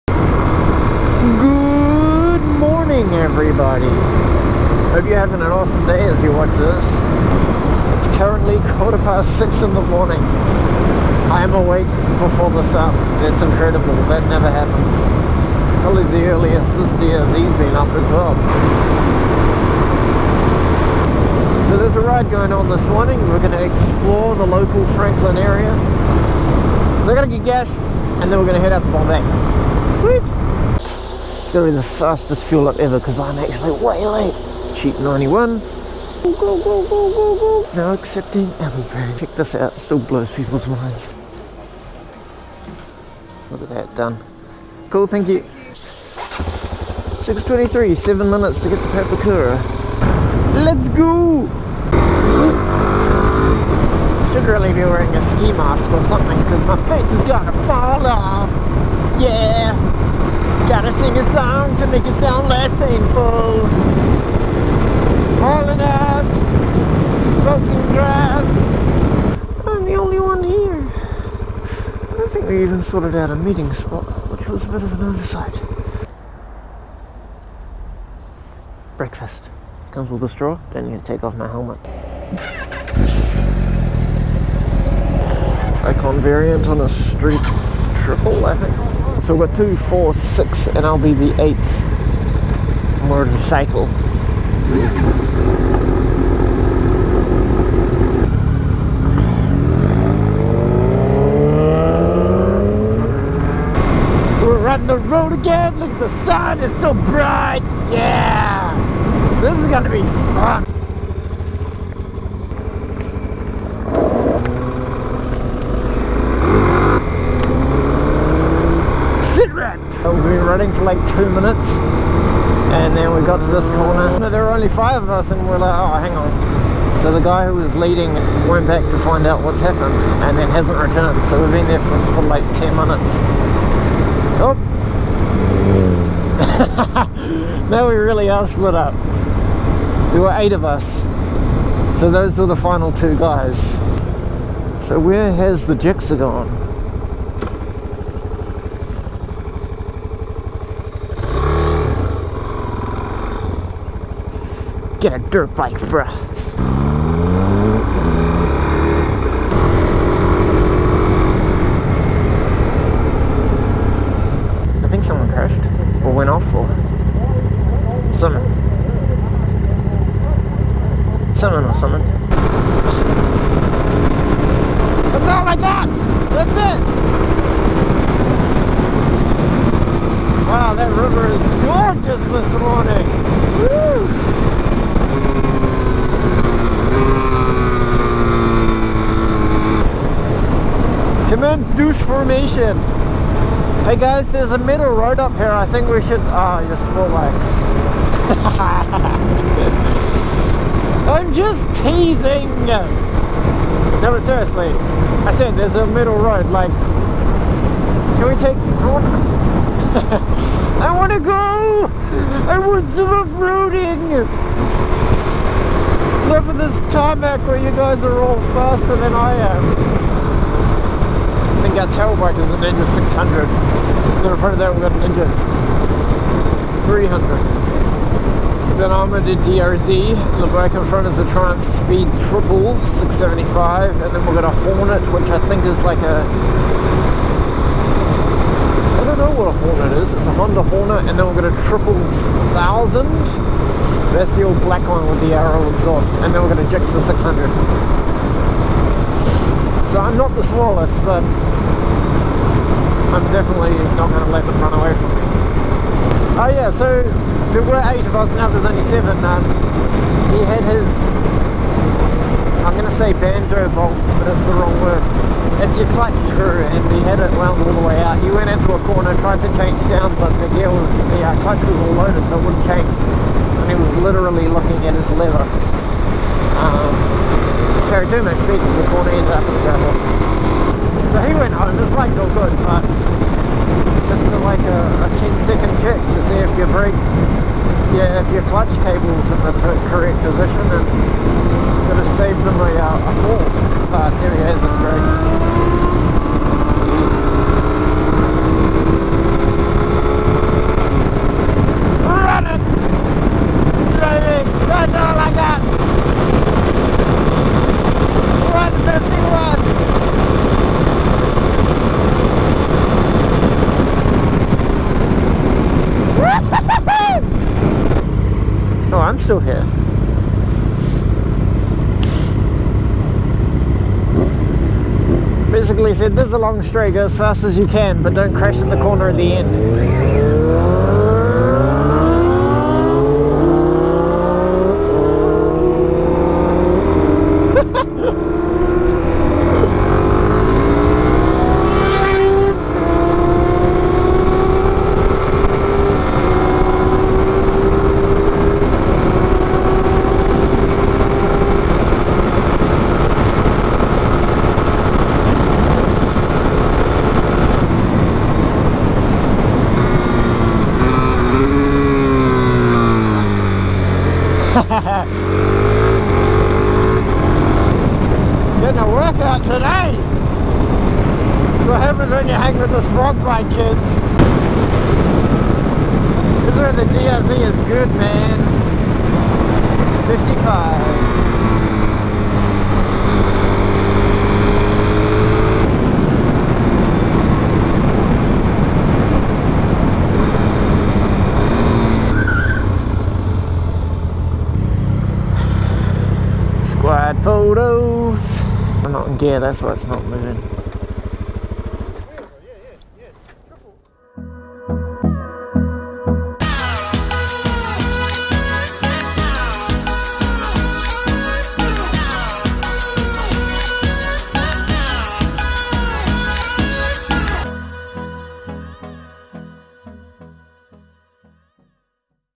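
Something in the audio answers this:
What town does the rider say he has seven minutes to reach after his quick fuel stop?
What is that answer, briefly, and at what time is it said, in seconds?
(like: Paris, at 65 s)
Papakura, at 48 s.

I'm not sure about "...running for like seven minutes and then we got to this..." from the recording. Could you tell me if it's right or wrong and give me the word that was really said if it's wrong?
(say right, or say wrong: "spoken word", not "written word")
wrong: "two", not "seven".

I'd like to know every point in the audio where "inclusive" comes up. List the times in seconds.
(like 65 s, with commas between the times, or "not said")
not said.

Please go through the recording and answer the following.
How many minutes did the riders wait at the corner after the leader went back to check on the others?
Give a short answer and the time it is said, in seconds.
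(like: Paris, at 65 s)
10, at 132 s.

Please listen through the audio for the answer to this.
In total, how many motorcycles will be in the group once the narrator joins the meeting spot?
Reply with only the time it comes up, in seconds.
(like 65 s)
91 s.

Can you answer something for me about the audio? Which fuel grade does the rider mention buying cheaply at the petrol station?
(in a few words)
91.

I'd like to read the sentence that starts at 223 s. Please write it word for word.
And then in front of that we've got a Ninja 300.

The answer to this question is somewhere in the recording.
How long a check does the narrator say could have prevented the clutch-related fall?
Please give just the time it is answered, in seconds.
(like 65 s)
285 s.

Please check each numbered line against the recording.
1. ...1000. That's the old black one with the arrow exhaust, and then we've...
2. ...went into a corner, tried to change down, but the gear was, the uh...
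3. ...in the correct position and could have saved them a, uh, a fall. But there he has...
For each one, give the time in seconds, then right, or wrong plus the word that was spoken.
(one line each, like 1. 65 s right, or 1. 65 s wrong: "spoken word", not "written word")
1. 241 s right
2. 268 s right
3. 289 s right.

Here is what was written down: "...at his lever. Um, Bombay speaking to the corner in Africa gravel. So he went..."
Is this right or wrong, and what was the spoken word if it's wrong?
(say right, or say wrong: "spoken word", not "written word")
wrong: "Aeroduma", not "Bombay".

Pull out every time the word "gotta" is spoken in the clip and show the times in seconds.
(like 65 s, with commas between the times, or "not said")
27 s, 60 s.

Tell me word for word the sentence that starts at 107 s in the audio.
Yeah, this is gonna be fun.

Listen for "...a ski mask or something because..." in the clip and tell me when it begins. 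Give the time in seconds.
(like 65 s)
55 s.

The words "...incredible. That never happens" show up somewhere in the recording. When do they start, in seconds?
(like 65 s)
13 s.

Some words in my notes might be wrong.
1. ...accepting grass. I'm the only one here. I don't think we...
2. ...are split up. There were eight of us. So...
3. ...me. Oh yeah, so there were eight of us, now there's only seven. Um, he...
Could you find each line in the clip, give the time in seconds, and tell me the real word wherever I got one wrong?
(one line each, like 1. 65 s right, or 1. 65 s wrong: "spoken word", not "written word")
1. 67 s wrong: "smoking", not "accepting"
2. 138 s right
3. 255 s right.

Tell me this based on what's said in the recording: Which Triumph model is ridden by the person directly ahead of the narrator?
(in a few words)
Speed Triple 675.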